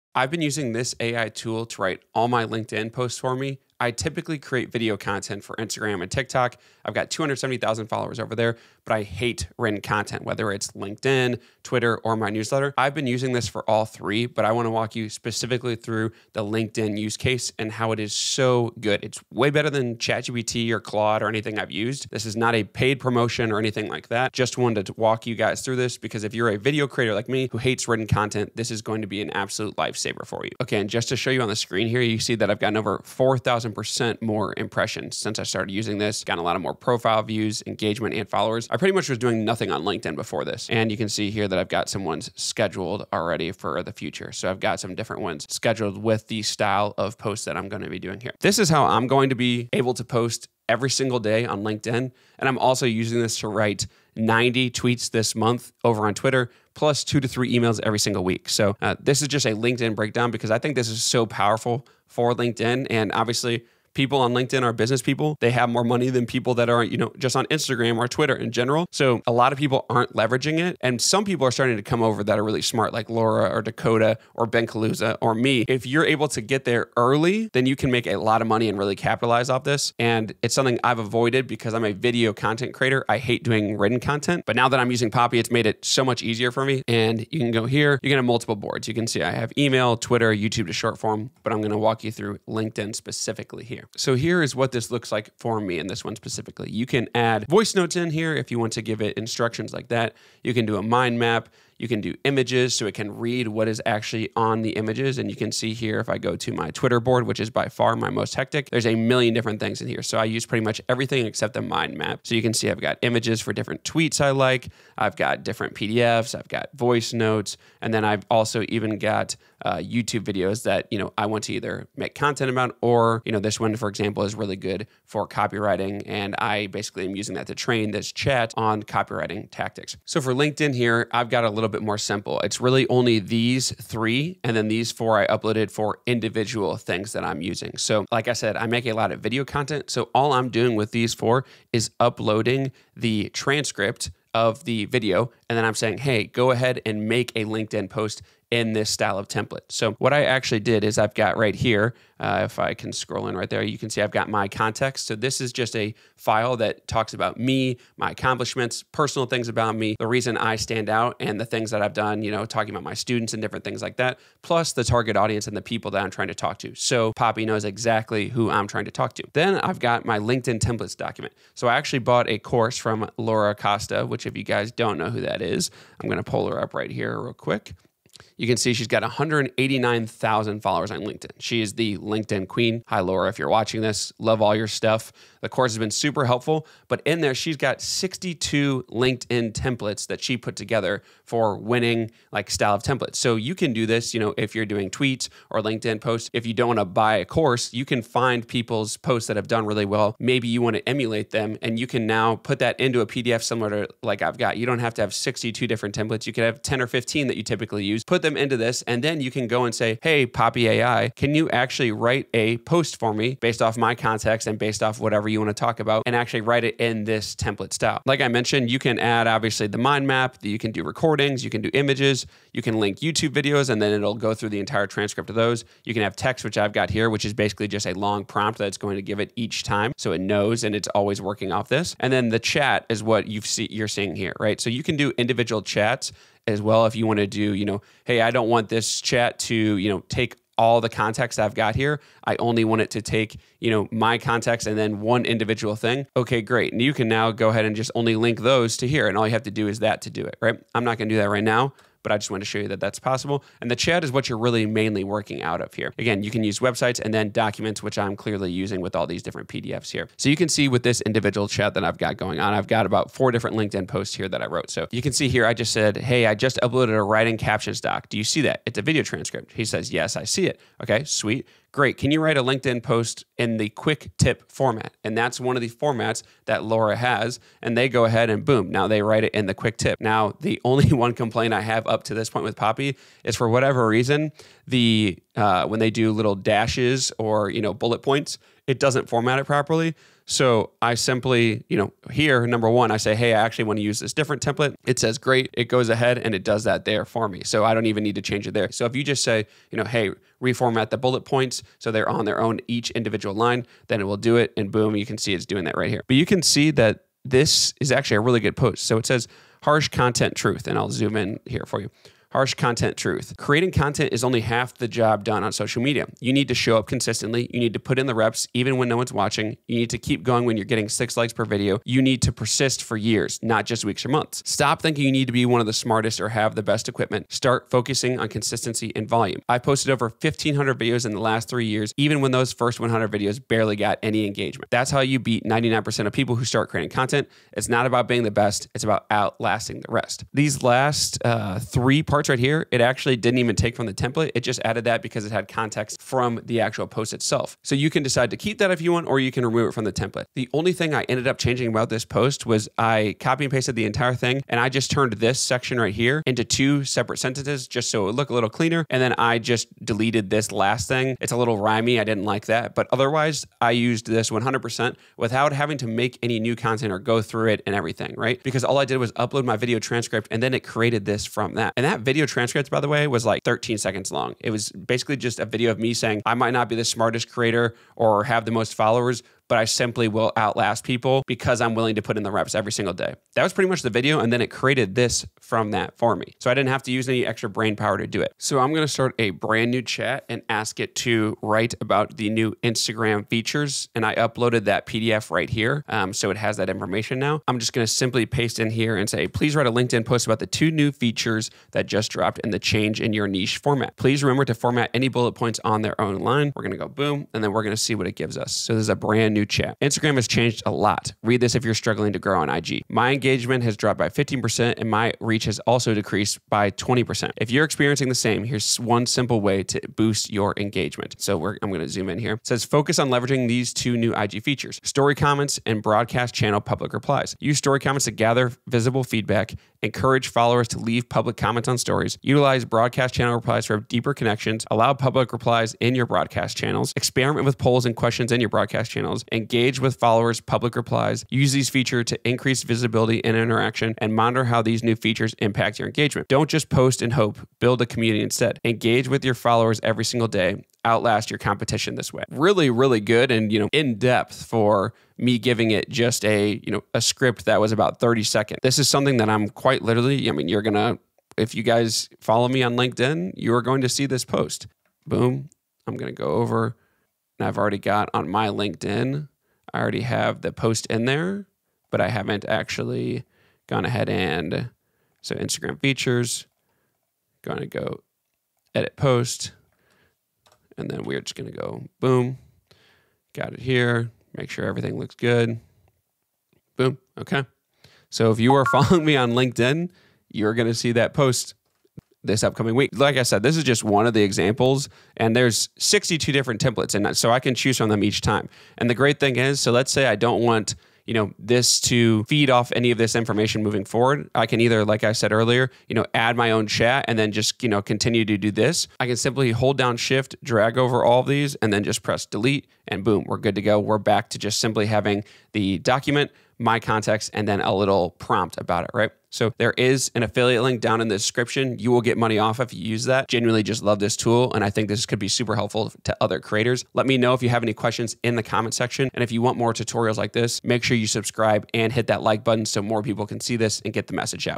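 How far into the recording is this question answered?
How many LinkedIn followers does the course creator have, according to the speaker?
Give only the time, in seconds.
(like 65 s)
179 s.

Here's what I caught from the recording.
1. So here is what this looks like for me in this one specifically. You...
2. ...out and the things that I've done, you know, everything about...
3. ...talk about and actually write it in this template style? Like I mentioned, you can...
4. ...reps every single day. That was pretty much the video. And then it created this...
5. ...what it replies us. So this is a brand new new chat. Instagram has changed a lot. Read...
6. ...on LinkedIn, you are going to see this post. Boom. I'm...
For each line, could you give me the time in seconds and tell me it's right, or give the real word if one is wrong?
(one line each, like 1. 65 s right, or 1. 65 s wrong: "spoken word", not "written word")
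1. 93 s right
2. 160 s wrong: "talking", not "everything"
3. 215 s right
4. 382 s right
5. 407 s wrong: "gives", not "replies"
6. 462 s right.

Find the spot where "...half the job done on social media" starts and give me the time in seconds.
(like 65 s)
314 s.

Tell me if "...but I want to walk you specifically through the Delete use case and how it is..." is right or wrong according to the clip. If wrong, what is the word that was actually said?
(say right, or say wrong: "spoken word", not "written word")
wrong: "LinkedIn", not "Delete".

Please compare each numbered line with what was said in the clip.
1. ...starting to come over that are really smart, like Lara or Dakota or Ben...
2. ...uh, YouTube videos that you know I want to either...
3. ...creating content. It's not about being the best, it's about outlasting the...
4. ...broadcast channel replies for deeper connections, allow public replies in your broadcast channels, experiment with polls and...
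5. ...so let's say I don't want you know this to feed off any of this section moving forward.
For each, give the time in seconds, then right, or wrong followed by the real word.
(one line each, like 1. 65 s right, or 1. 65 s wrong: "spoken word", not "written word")
1. 71 s right
2. 119 s right
3. 336 s right
4. 432 s right
5. 499 s wrong: "information", not "section".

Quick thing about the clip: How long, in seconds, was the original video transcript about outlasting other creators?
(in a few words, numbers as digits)
13 seconds.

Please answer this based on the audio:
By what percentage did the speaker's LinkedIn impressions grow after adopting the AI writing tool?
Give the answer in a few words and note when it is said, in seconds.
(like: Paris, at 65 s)
4,000%, at 32 s.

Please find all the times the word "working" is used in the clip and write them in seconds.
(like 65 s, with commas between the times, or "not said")
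231 s, 255 s.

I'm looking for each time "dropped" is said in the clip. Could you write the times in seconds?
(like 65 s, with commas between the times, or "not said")
402 s, 413 s.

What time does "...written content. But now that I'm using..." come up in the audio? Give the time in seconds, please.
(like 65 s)
83 s.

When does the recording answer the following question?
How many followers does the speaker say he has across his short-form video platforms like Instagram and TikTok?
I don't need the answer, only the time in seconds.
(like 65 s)
7 s.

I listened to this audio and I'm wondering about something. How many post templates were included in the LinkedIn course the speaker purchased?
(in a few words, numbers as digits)
62.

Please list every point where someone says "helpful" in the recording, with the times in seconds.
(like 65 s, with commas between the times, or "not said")
186 s, 525 s.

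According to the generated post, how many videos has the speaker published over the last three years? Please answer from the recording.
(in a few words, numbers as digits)
1,500.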